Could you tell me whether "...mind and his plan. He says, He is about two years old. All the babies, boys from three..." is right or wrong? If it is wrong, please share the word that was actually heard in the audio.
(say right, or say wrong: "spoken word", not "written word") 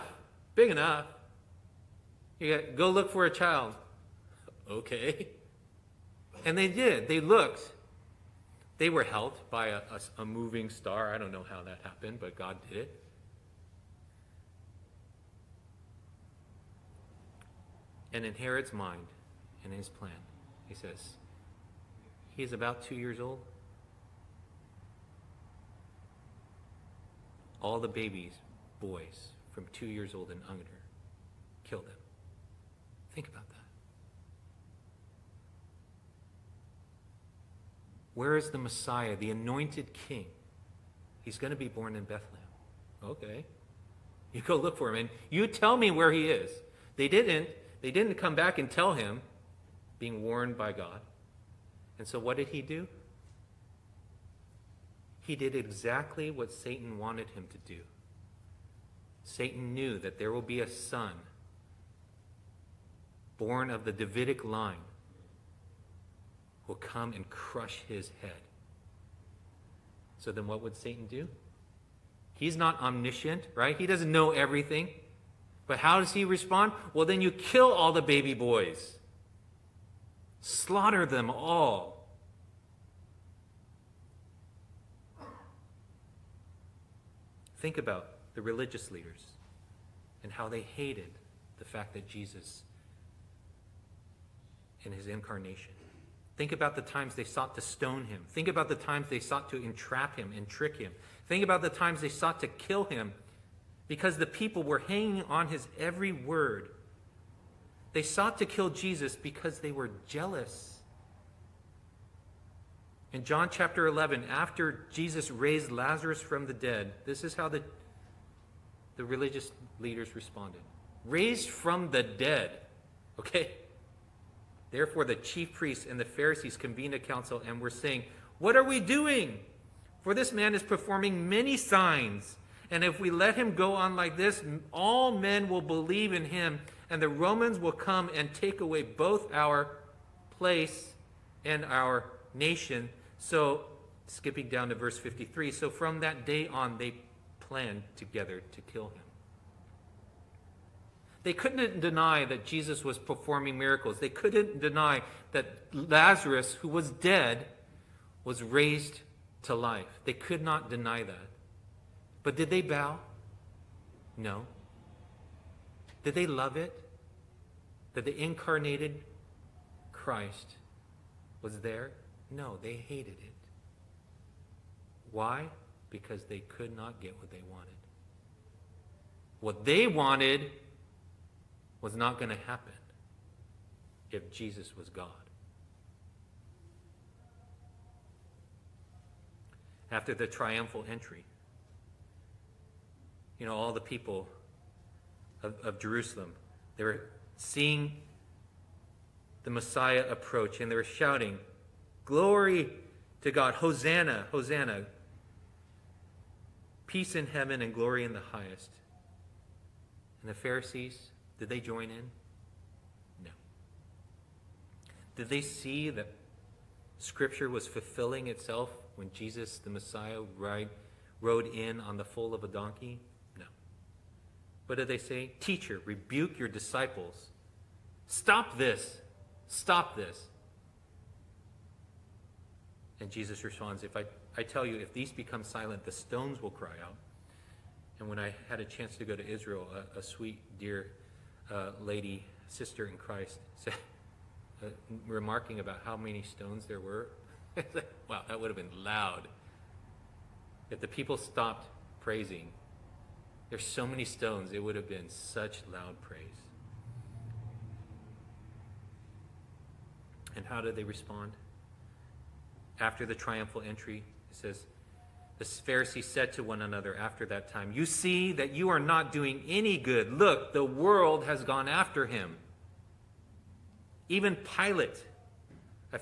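wrong: "two", not "three".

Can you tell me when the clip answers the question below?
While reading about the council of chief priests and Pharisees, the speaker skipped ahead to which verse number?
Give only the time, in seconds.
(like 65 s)
144 s.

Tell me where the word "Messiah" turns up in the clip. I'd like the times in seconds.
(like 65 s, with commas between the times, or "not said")
38 s, 199 s, 219 s.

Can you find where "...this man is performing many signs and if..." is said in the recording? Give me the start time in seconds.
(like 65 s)
130 s.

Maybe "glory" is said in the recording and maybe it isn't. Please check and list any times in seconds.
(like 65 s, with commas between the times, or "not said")
202 s, 207 s.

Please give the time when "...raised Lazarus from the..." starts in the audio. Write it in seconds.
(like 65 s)
115 s.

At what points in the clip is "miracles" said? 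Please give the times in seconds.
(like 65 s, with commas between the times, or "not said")
153 s.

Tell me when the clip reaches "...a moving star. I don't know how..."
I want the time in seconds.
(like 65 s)
10 s.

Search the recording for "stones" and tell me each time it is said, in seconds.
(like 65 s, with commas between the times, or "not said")
97 s, 235 s, 246 s, 254 s.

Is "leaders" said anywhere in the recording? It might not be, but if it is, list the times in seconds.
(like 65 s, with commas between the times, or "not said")
88 s, 119 s.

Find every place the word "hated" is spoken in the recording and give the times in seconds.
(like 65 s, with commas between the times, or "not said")
90 s, 172 s.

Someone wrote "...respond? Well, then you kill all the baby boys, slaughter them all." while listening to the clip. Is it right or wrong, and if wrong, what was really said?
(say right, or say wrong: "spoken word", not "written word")
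right.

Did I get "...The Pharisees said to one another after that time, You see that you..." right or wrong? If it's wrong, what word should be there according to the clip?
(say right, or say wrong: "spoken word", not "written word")
right.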